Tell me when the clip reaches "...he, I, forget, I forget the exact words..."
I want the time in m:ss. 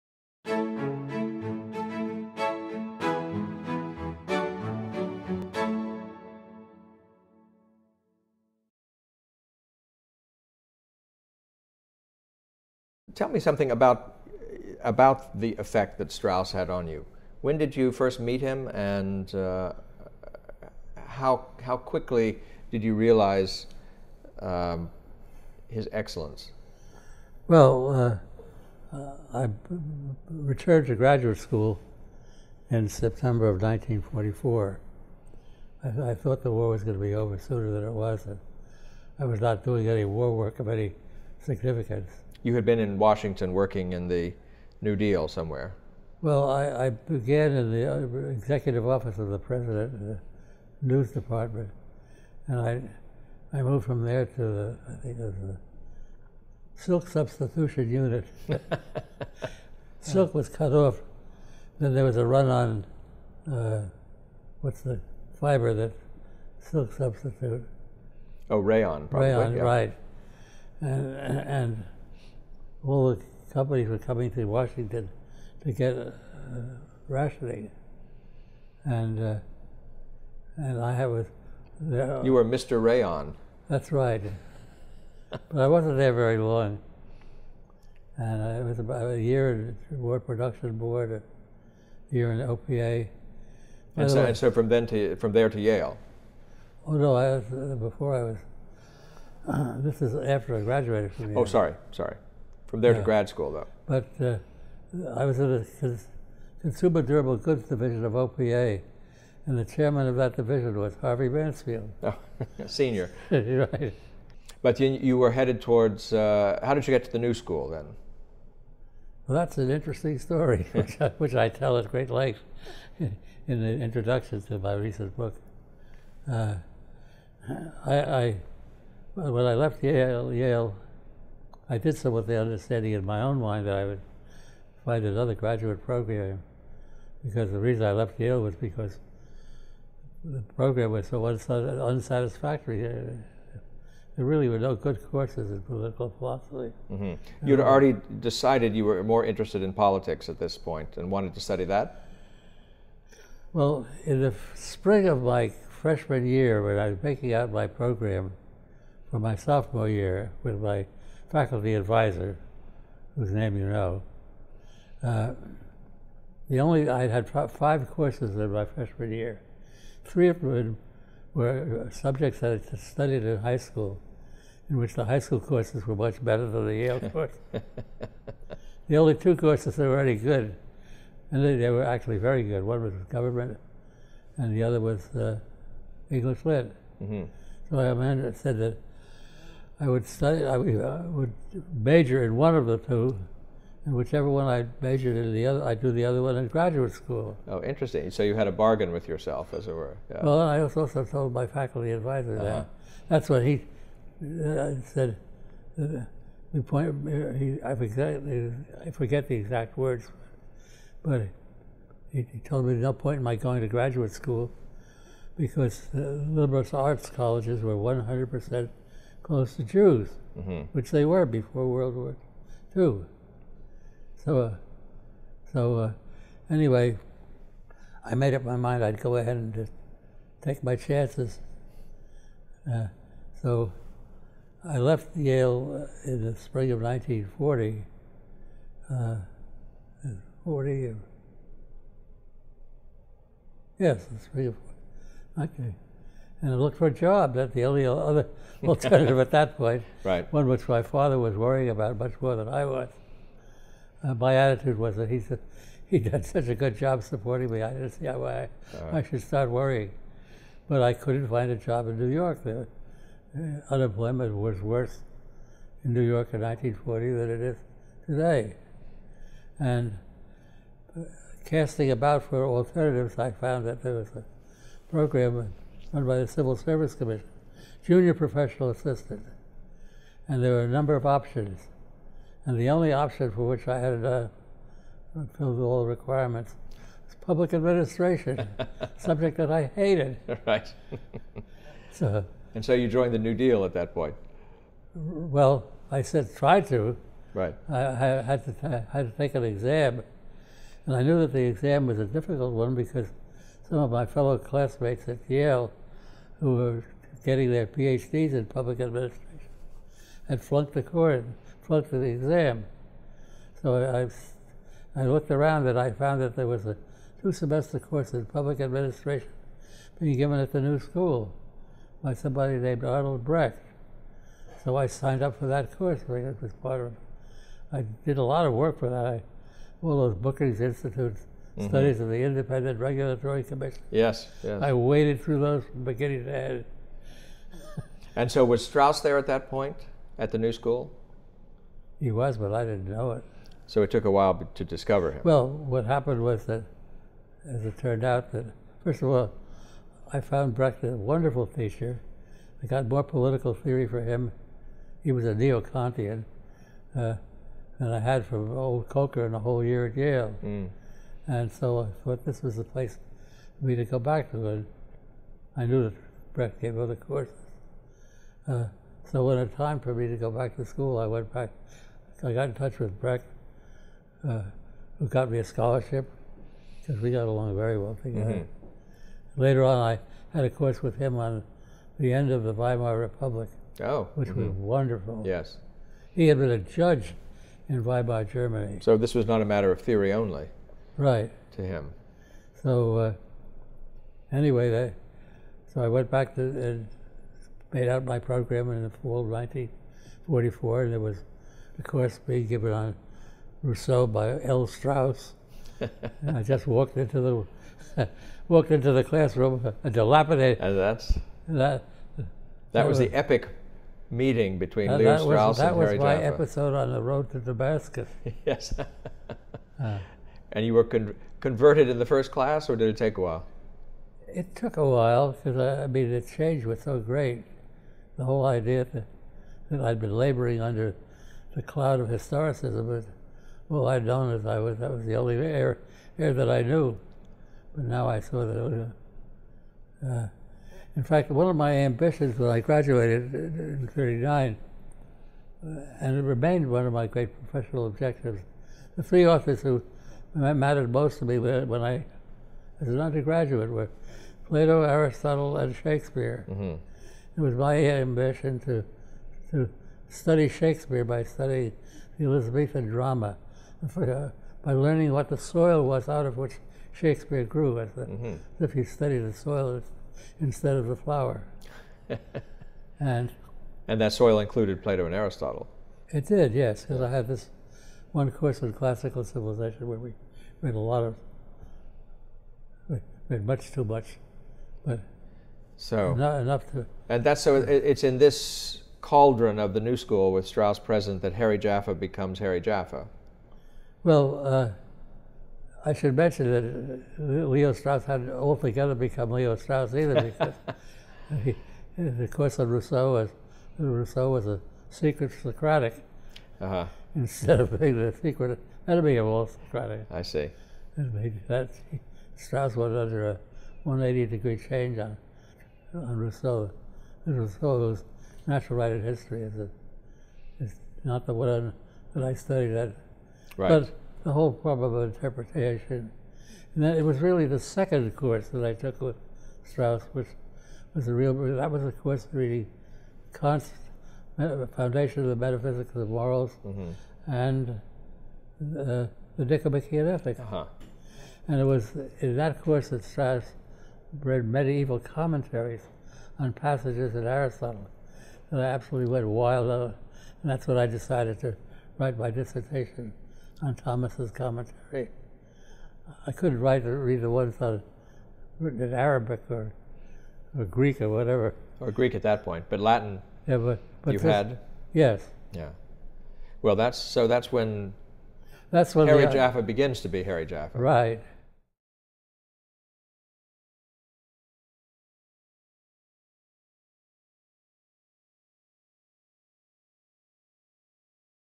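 3:27.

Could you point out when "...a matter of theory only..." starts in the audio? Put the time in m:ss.
6:29.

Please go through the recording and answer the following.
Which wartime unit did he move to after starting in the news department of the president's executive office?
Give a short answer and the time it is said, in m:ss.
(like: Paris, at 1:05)
Silk substitution unit, at 0:56.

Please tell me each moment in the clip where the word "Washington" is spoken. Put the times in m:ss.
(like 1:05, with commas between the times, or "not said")
0:42, 1:14.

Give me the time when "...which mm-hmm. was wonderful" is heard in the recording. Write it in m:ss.
6:24.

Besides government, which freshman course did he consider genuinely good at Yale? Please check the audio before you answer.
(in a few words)
English lit.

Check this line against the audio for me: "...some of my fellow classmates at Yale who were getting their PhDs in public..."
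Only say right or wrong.
right.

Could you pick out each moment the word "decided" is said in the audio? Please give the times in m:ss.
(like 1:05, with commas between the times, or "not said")
2:28, 9:10.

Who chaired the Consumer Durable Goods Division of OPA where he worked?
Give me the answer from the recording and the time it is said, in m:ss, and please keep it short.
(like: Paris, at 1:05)
Harvey Mansfield, at 1:51.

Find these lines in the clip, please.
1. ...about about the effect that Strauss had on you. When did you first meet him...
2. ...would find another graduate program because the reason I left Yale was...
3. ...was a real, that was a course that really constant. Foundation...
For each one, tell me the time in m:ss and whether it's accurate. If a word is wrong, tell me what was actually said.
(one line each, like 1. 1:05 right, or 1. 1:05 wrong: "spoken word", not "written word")
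1. 0:13 right
2. 2:13 right
3. 8:50 right.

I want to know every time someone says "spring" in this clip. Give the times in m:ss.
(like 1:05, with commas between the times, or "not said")
2:34, 3:56, 4:04.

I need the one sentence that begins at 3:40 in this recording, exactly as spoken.
which they were before World War II.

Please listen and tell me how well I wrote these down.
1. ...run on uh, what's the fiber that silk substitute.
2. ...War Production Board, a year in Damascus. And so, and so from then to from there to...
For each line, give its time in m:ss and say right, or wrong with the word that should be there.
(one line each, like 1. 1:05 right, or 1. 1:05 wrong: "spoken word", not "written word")
1. 1:02 right
2. 1:30 wrong: "OPA", not "Damascus".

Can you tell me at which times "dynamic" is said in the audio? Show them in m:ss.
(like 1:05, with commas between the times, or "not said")
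not said.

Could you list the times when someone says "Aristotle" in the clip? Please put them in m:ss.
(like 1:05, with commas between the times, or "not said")
7:34, 7:55, 9:07.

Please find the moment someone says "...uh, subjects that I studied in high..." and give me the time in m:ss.
2:51.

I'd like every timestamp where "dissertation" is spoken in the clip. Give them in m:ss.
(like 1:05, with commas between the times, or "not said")
9:12.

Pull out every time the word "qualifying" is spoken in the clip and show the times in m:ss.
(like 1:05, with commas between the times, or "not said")
not said.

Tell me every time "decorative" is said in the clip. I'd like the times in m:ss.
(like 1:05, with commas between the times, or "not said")
not said.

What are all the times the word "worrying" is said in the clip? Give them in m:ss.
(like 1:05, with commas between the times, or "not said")
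4:11, 4:19.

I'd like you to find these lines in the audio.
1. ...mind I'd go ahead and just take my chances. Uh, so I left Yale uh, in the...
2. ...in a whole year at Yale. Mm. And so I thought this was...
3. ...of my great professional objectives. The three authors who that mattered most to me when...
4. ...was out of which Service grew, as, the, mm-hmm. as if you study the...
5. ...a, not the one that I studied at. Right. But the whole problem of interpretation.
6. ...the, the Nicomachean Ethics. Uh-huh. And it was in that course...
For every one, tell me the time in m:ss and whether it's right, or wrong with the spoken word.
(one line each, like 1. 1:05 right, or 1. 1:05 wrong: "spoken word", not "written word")
1. 3:48 right
2. 5:59 right
3. 7:26 right
4. 7:45 wrong: "Shakespeare", not "Service"
5. 8:39 right
6. 8:58 right.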